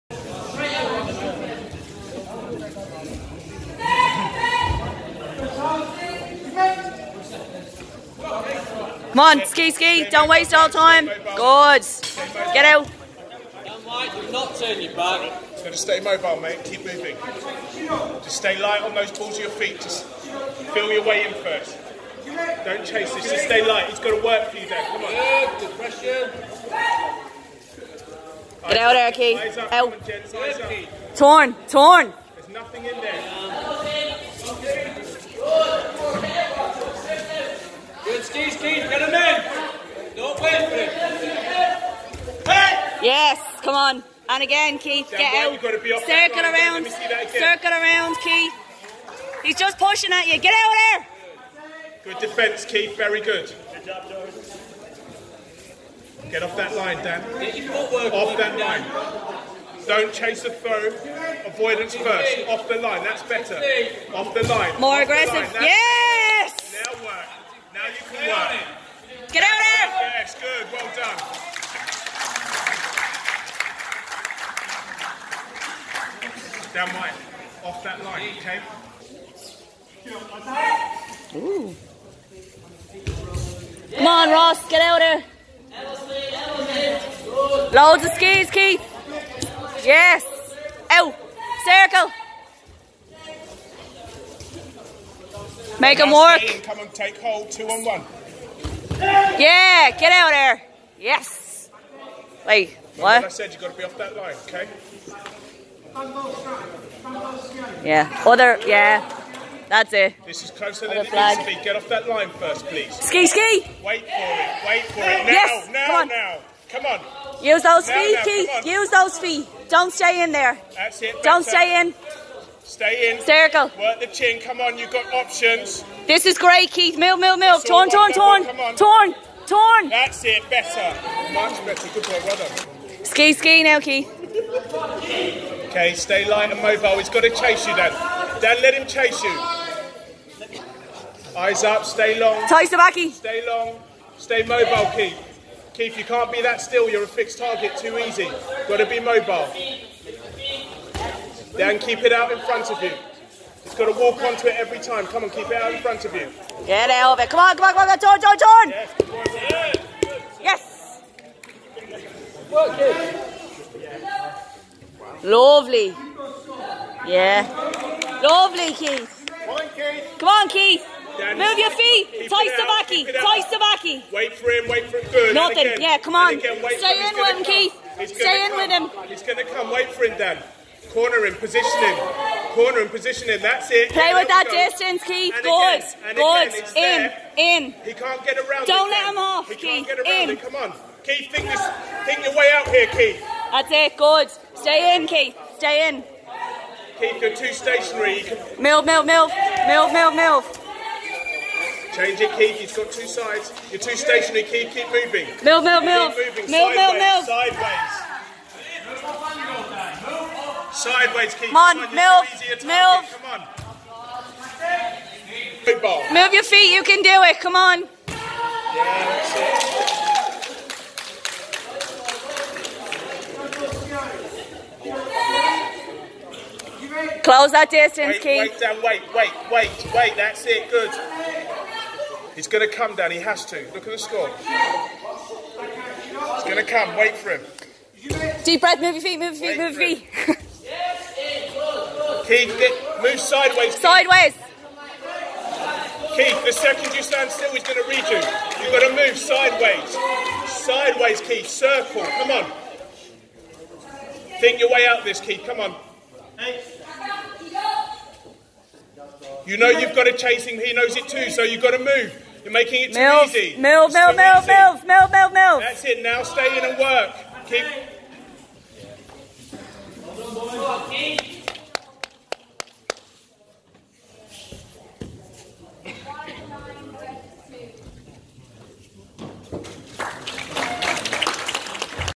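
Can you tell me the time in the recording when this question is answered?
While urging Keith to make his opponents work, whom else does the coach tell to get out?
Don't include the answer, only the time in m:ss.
1:24.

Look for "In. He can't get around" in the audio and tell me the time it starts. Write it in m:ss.
3:07.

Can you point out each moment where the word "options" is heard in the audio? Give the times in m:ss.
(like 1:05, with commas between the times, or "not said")
2:05.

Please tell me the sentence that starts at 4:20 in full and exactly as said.
He knows it too, so you've got to move.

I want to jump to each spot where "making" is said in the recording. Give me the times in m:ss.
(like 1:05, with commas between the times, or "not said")
4:22.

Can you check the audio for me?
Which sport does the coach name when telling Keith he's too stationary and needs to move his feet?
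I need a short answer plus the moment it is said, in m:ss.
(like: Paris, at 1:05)
Football, at 3:35.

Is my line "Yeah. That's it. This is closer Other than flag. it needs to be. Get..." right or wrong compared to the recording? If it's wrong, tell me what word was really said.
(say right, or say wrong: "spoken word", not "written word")
right.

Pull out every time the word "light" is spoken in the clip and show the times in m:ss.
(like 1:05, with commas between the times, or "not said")
0:18, 0:23, 2:16.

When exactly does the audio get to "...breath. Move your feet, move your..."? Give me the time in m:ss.
3:58.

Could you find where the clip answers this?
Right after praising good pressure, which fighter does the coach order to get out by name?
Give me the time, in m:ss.
0:28.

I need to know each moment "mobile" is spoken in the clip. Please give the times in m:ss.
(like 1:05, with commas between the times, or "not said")
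0:15, 2:16, 2:24, 2:28.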